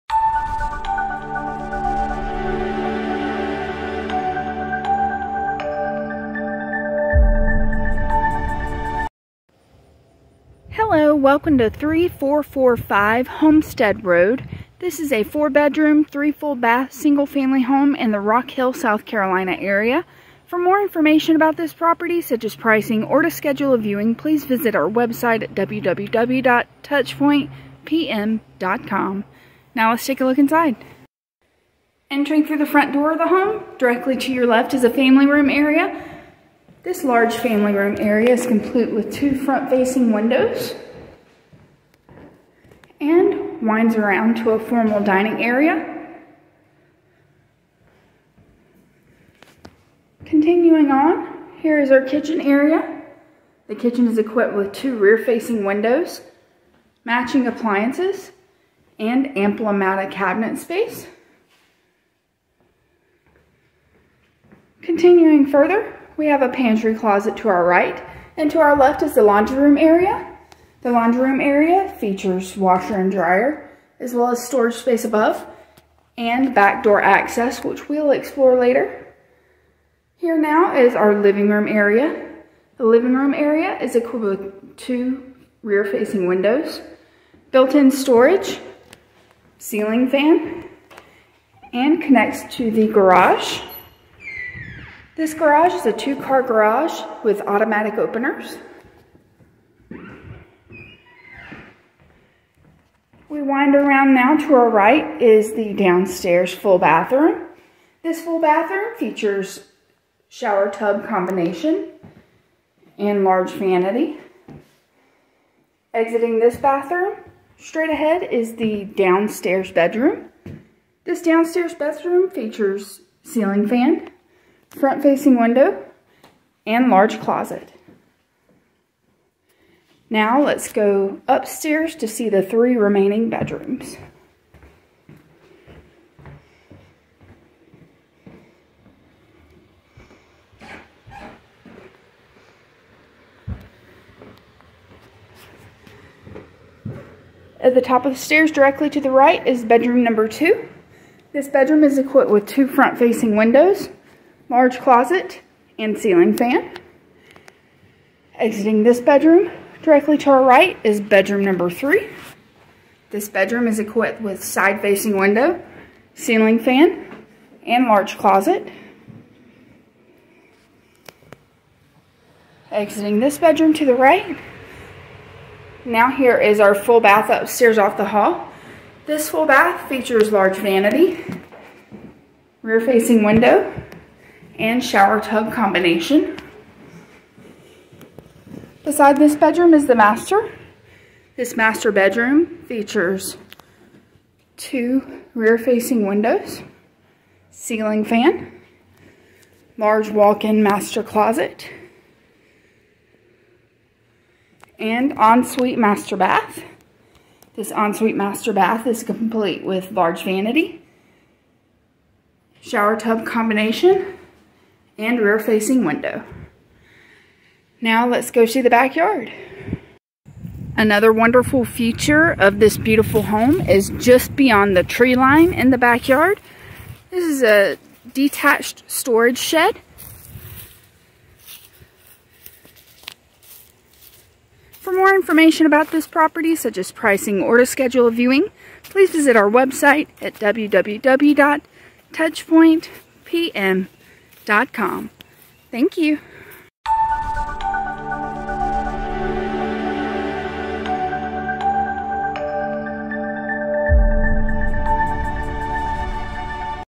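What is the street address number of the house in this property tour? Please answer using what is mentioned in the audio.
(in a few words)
3445.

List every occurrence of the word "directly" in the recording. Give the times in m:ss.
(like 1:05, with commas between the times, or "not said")
0:33, 2:28, 2:39.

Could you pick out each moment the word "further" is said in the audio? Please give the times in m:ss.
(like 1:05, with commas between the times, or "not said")
1:05.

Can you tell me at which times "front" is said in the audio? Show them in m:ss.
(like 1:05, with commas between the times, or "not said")
0:32, 0:39, 2:04, 2:32.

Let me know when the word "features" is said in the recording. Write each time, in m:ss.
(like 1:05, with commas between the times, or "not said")
1:11, 1:48, 2:02, 2:59, 3:12, 3:41.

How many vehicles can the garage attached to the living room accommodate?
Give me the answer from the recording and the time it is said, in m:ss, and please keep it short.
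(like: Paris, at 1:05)
two-car, at 1:35.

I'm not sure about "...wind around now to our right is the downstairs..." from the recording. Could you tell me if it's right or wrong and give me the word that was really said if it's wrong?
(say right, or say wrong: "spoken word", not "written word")
right.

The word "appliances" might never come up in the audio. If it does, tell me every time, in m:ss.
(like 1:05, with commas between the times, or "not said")
0:57.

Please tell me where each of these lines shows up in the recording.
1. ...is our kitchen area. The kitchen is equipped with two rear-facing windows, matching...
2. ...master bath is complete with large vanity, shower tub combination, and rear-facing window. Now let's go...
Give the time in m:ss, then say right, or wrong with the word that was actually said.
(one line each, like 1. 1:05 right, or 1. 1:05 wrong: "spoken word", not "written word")
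1. 0:51 right
2. 3:28 right.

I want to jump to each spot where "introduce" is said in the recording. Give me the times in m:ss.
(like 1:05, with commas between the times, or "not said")
not said.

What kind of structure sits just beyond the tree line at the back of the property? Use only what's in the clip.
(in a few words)
detached storage shed.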